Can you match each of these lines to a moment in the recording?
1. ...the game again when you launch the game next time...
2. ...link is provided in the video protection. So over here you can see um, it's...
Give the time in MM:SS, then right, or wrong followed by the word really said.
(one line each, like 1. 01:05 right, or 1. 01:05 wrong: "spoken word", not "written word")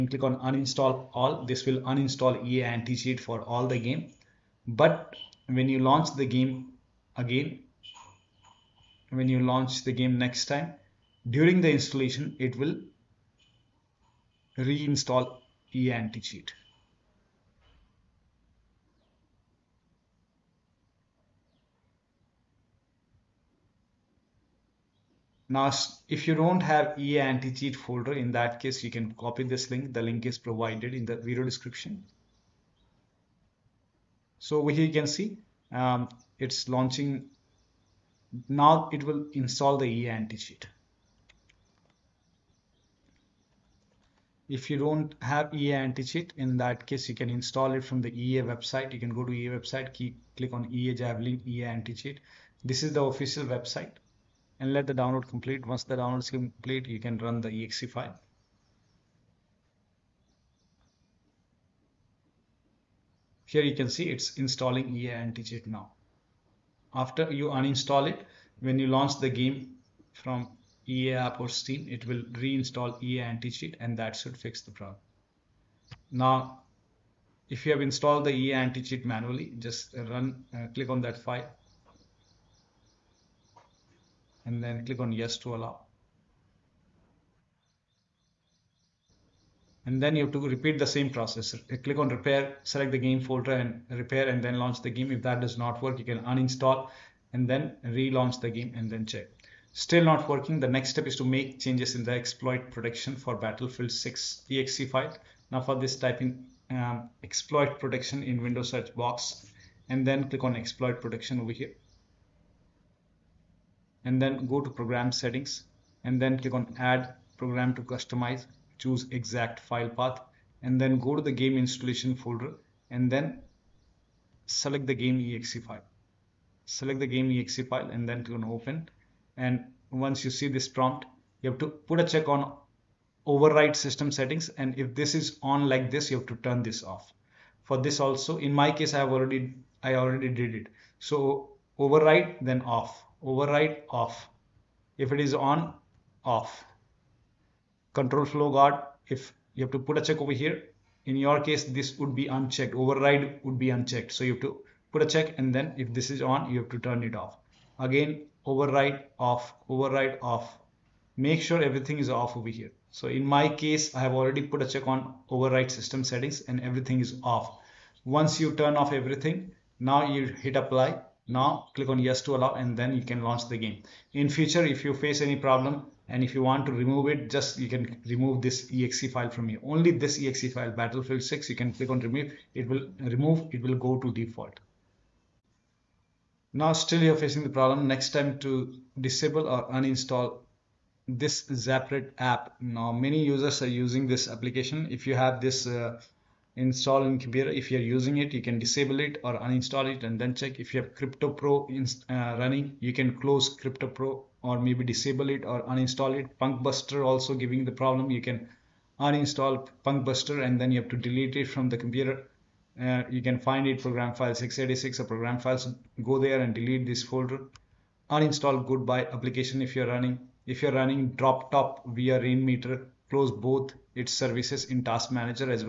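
1. 00:06 right
2. 00:30 wrong: "description", not "protection".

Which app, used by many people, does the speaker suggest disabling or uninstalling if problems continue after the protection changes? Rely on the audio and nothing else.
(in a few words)
zapret.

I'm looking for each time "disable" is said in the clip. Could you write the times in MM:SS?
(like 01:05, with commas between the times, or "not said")
03:09, 03:18, 03:24.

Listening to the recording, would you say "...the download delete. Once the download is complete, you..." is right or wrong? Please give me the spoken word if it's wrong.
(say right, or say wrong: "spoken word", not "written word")
wrong: "complete", not "delete".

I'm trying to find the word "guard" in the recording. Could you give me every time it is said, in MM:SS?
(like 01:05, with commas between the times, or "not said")
02:28.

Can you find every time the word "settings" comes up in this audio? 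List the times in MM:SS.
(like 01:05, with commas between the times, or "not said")
01:55, 02:14, 02:46.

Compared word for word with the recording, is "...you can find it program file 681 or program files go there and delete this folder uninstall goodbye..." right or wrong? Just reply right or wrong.
wrong.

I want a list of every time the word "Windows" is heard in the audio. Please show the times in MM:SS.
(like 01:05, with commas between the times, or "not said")
01:48.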